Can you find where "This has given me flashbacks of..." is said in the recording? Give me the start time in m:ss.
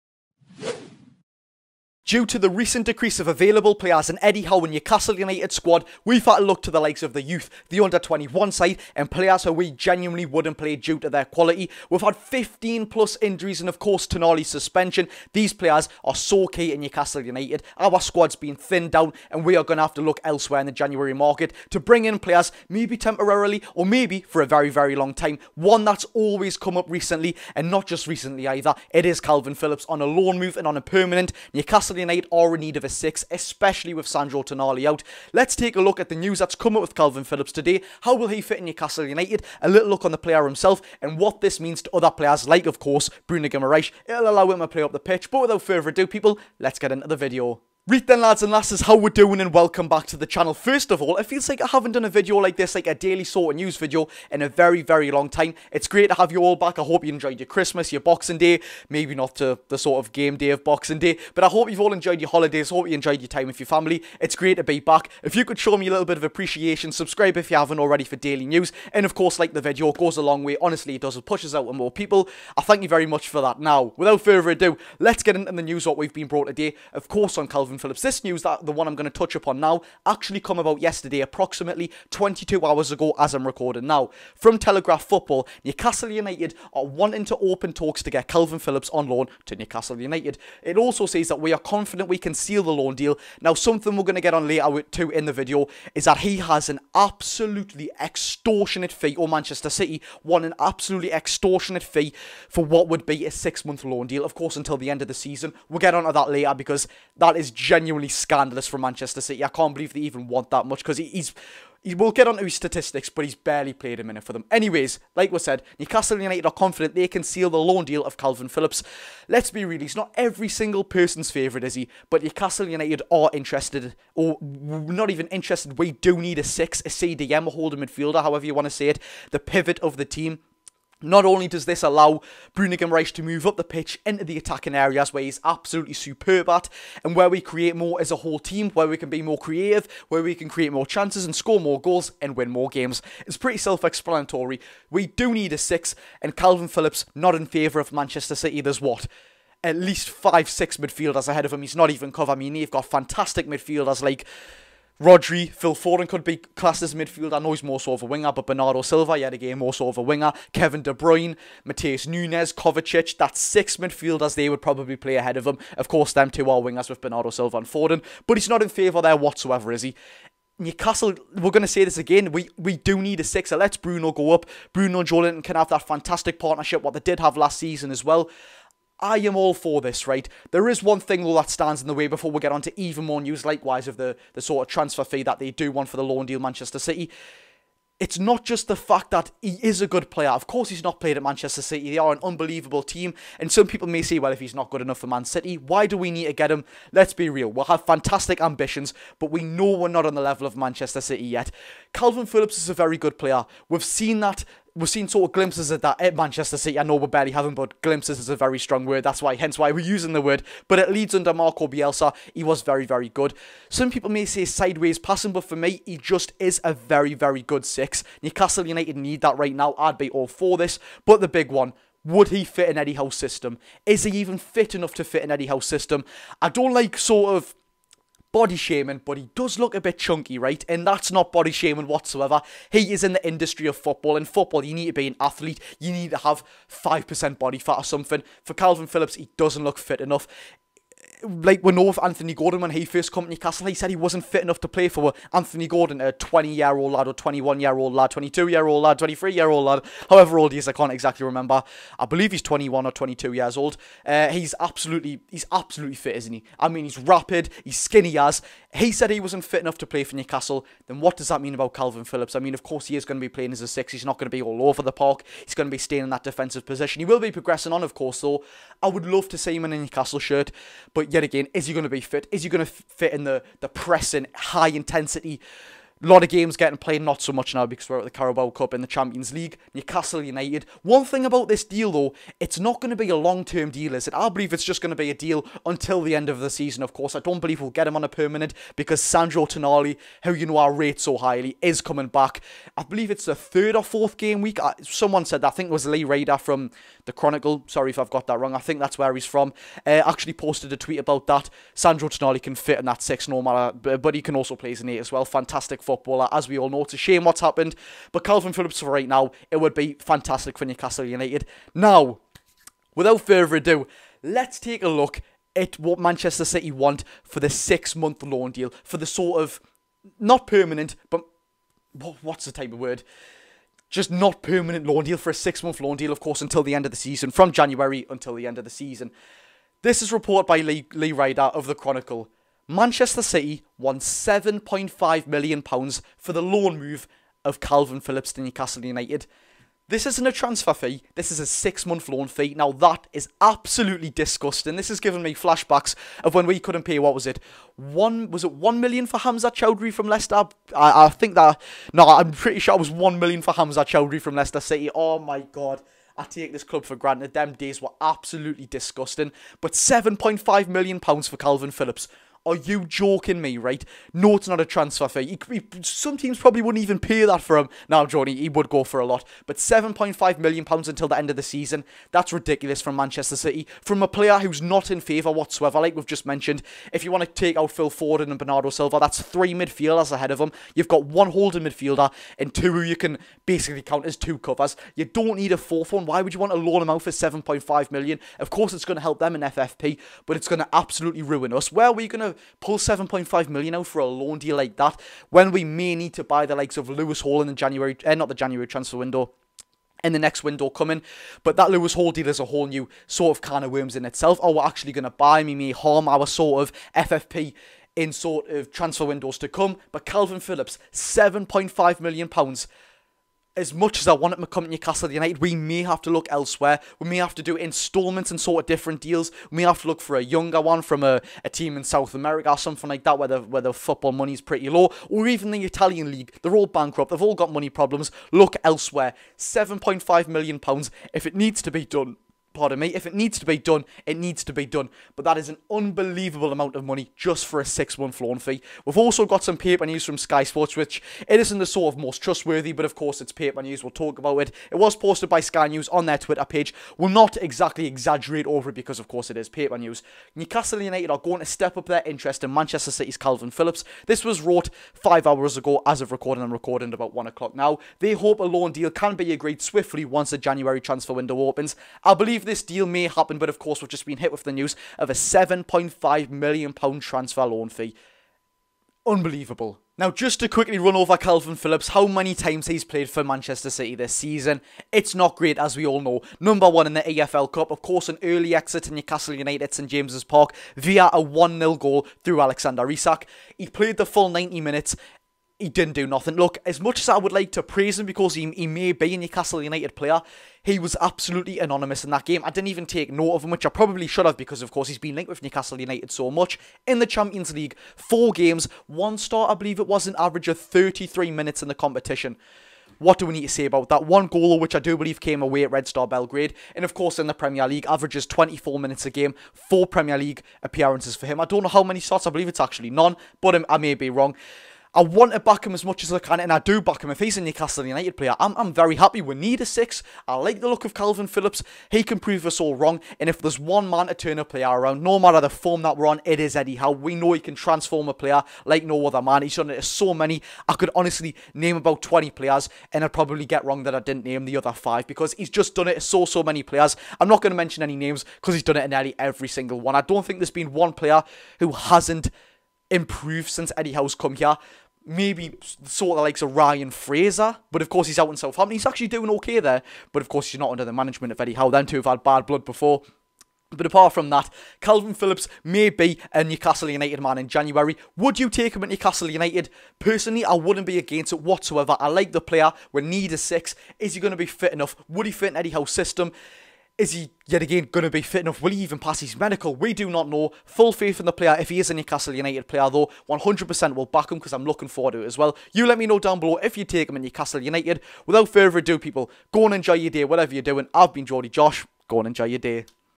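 5:44.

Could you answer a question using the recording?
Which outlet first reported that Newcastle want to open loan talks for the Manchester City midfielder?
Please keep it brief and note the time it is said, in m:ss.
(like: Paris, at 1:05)
Telegraph Football, at 1:24.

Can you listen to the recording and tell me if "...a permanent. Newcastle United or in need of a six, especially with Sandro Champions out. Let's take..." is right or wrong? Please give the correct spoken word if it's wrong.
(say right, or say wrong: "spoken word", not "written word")
wrong: "Tonali", not "Champions".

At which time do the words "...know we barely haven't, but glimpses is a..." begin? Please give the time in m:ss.
3:26.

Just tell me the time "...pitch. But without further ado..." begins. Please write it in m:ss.
0:44.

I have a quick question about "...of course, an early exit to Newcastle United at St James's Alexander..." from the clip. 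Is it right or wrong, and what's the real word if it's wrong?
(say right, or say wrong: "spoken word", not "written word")
wrong: "Park", not "Alexander".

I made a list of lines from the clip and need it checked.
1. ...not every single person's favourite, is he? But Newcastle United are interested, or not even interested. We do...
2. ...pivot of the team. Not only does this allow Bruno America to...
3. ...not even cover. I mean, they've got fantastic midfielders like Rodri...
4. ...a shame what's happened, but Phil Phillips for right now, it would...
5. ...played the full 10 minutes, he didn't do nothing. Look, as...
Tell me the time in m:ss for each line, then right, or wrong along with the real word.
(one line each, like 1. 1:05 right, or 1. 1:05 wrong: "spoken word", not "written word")
1. 1:59 right
2. 2:09 wrong: "Reich", not "America"
3. 2:31 right
4. 5:06 wrong: "Kalvin", not "Phil"
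5. 8:03 wrong: "90", not "10".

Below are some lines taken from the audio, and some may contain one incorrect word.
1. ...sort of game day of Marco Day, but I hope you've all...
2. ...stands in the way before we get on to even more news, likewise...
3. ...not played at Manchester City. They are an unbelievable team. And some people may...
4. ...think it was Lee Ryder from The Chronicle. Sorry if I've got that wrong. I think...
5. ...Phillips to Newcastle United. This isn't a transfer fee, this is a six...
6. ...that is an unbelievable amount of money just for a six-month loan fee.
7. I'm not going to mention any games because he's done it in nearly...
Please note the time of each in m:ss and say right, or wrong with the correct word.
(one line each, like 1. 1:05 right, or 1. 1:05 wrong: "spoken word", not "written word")
1. 0:59 wrong: "Boxing", not "Marco"
2. 3:01 right
3. 3:10 right
4. 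4:55 right
5. 5:38 right
6. 7:15 right
7. 8:57 wrong: "names", not "games".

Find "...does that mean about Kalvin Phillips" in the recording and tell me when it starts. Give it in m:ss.
4:21.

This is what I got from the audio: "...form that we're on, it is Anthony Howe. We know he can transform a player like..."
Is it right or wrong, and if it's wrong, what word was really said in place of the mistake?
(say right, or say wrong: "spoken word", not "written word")
wrong: "Eddie", not "Anthony".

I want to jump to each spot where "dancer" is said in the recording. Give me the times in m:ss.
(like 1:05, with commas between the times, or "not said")
not said.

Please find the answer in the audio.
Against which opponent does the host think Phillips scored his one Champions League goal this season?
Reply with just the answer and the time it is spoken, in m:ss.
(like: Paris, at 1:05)
Red Star Belgrade, at 8:25.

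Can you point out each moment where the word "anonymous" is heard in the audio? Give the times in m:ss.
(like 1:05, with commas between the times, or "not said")
8:11.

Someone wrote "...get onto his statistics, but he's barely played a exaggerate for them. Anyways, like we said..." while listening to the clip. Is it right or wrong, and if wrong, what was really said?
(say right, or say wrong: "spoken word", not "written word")
wrong: "minute", not "exaggerate".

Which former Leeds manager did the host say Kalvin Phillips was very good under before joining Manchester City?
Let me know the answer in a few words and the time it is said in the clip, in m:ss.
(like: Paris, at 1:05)
Marco Bielsa, at 3:31.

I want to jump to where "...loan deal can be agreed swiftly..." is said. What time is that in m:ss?
7:38.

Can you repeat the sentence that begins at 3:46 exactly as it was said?
I don't like sort of body shaming, but he does look a bit chunky, right?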